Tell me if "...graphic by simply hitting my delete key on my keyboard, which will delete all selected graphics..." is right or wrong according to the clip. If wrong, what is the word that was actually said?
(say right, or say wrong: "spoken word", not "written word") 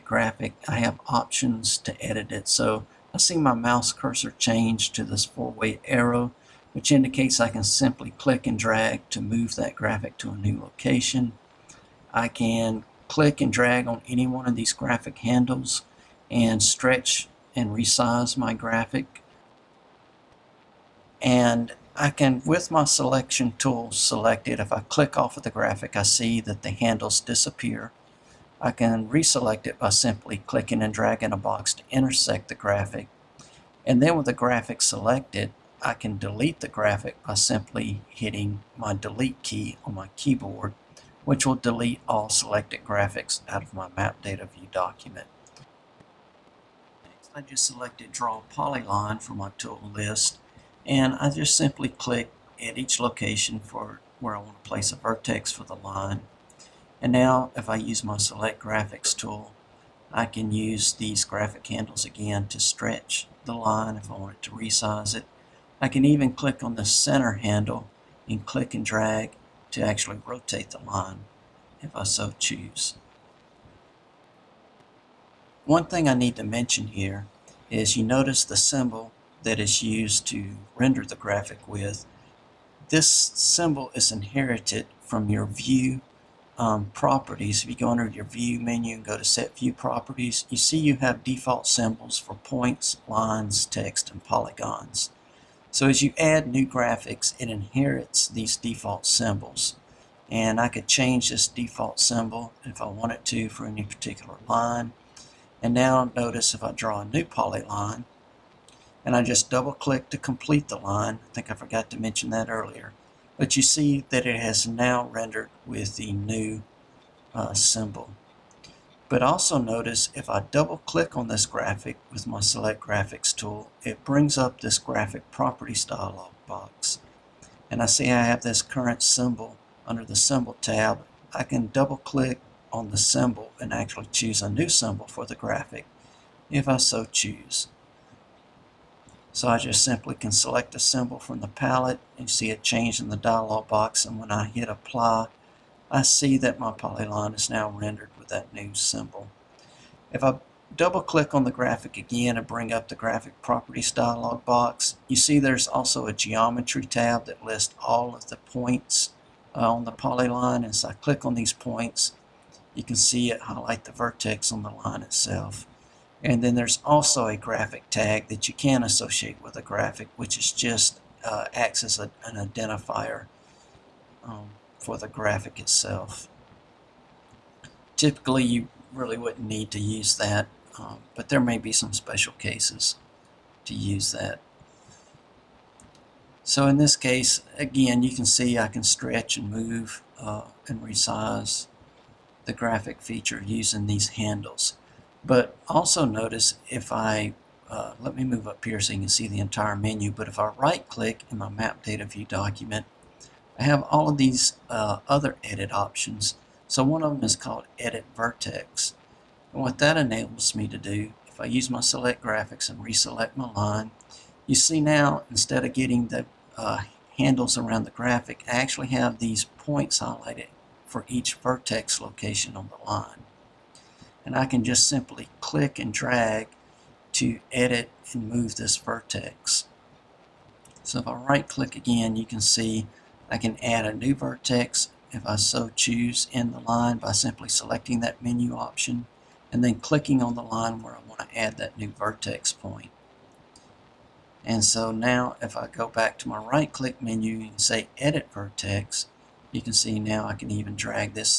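right.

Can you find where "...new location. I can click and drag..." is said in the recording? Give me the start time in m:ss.
0:10.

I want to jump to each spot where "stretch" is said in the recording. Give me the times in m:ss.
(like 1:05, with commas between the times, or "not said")
0:16, 1:02, 3:08.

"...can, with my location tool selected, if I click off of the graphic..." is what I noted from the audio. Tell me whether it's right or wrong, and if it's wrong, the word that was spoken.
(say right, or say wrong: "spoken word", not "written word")
wrong: "selection", not "location".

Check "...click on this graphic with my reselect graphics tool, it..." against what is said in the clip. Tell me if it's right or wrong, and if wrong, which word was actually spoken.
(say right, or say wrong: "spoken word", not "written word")
wrong: "select", not "reselect".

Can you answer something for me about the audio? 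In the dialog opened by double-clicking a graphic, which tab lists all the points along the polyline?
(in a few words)
geometry tab.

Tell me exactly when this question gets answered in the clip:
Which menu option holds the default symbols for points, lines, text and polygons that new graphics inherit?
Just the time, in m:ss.
1:29.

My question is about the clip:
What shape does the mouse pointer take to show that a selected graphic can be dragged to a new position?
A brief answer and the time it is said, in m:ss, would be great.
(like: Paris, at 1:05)
four-way arrow, at 0:05.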